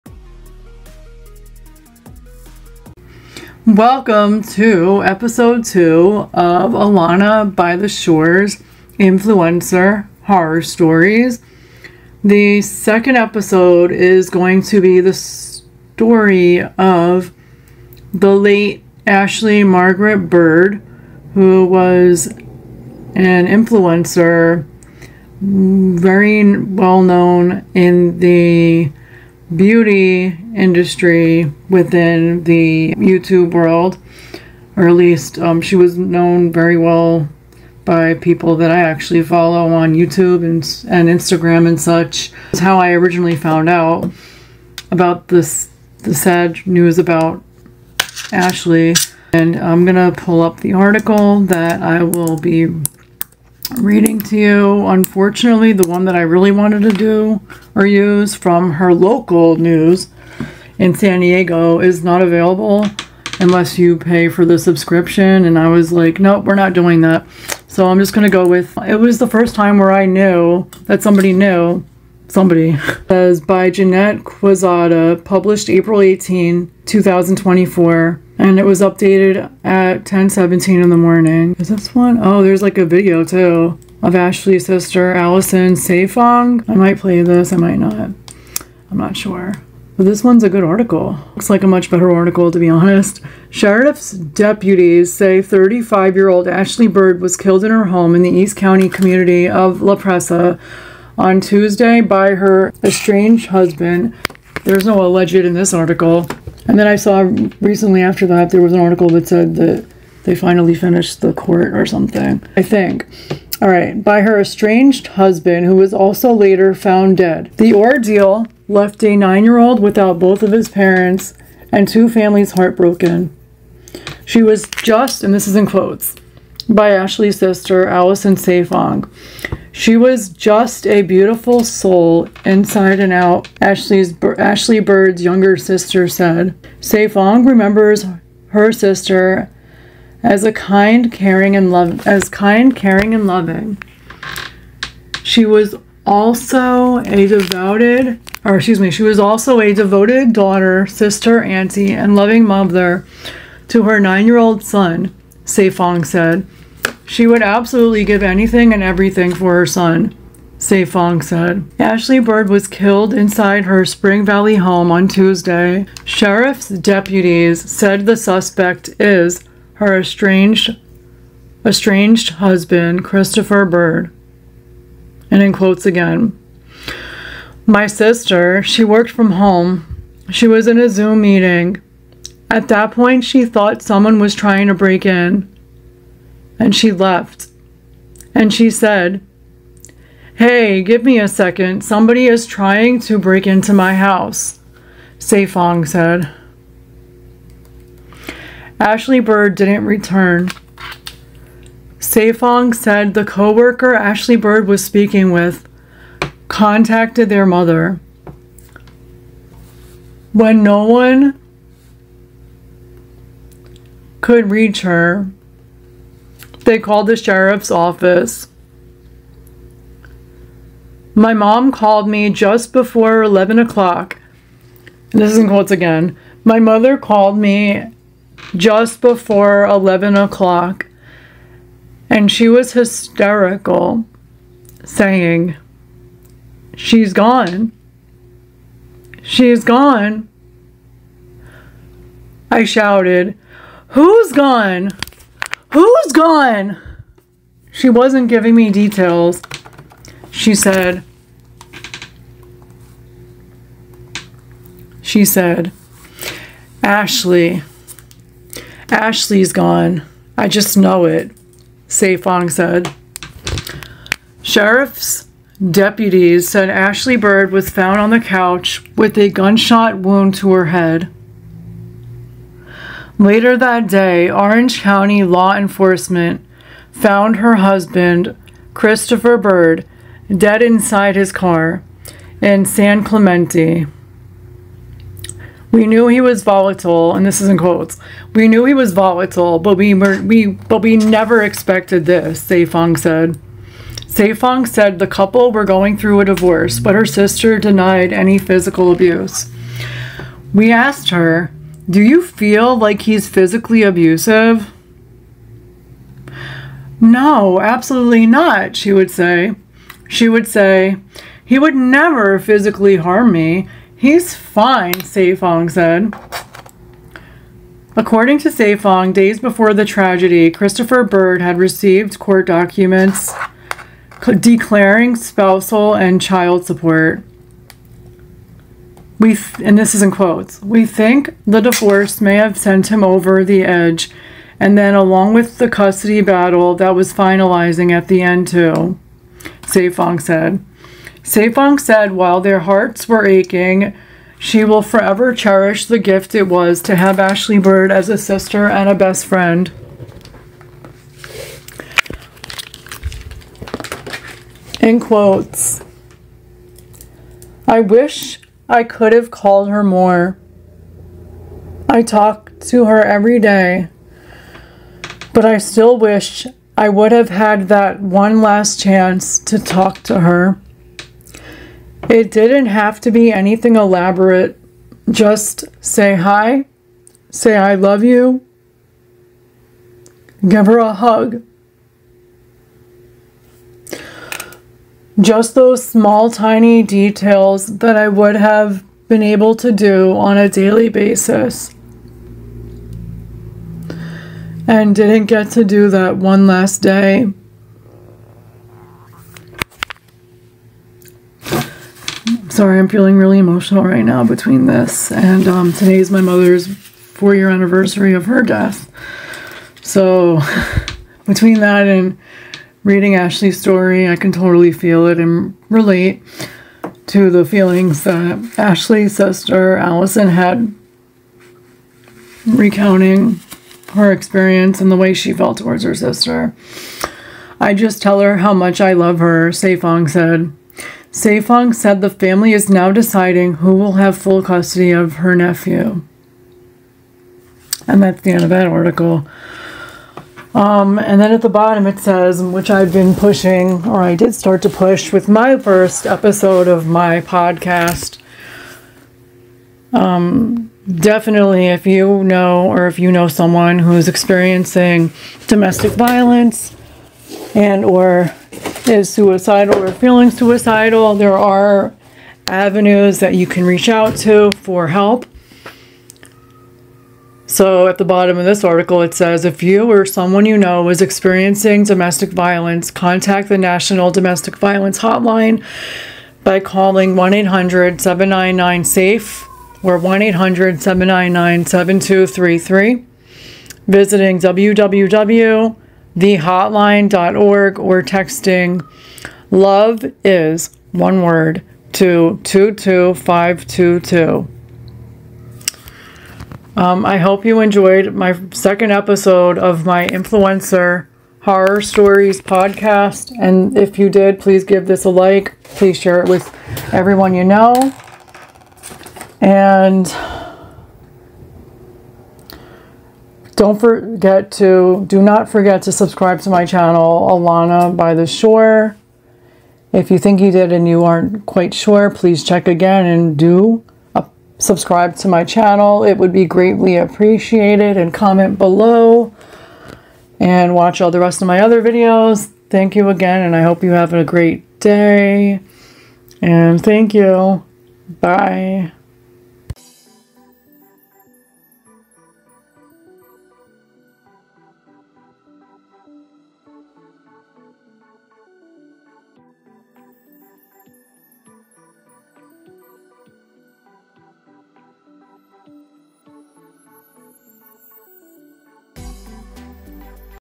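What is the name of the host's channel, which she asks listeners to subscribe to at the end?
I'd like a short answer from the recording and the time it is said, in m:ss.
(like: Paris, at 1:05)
Alana by the Shore, at 8:37.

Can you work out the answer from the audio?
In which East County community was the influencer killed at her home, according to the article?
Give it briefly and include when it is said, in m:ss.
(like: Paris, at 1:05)
La Presa, at 1:39.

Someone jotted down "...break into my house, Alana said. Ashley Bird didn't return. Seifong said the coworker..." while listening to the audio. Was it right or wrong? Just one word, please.
wrong.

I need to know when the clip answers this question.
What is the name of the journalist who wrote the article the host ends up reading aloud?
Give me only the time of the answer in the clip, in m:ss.
1:13.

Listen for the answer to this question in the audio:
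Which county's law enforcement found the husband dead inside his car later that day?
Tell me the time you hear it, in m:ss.
4:34.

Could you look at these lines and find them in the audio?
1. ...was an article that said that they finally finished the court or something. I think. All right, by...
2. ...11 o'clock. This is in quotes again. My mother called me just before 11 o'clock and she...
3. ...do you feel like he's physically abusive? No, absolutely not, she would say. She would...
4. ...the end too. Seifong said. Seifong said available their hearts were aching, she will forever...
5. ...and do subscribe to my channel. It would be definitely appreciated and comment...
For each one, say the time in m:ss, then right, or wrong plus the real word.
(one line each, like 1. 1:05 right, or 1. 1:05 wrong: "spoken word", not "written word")
1. 1:48 right
2. 3:43 right
3. 5:01 right
4. 5:38 wrong: "while", not "available"
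5. 8:43 wrong: "greatly", not "definitely".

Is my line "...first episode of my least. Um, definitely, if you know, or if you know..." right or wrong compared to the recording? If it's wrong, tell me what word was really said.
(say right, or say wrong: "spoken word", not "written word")
wrong: "podcast", not "least".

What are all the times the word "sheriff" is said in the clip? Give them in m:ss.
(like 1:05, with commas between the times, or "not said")
1:33, 2:46, 3:37, 4:24.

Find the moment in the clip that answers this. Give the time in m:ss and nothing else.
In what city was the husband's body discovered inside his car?
4:42.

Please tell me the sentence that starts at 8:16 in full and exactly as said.
Um, I hope you enjoyed my second episode of my influencer horror stories podcast.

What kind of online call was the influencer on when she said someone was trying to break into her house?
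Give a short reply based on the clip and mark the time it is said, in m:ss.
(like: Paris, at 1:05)
Zoom meeting, at 3:00.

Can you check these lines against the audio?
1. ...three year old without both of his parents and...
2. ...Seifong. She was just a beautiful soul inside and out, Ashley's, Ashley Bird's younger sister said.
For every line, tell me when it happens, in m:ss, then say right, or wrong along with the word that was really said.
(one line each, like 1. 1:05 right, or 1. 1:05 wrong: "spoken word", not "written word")
1. 1:59 wrong: "nine", not "three"
2. 2:08 right.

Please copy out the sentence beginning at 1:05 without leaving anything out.
And I was like, nope, we're not doing that.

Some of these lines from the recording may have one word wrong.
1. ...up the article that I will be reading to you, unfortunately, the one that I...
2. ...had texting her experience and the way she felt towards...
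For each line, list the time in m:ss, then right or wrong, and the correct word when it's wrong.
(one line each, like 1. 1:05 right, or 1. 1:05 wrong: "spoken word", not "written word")
1. 0:50 right
2. 7:00 wrong: "recounting", not "texting".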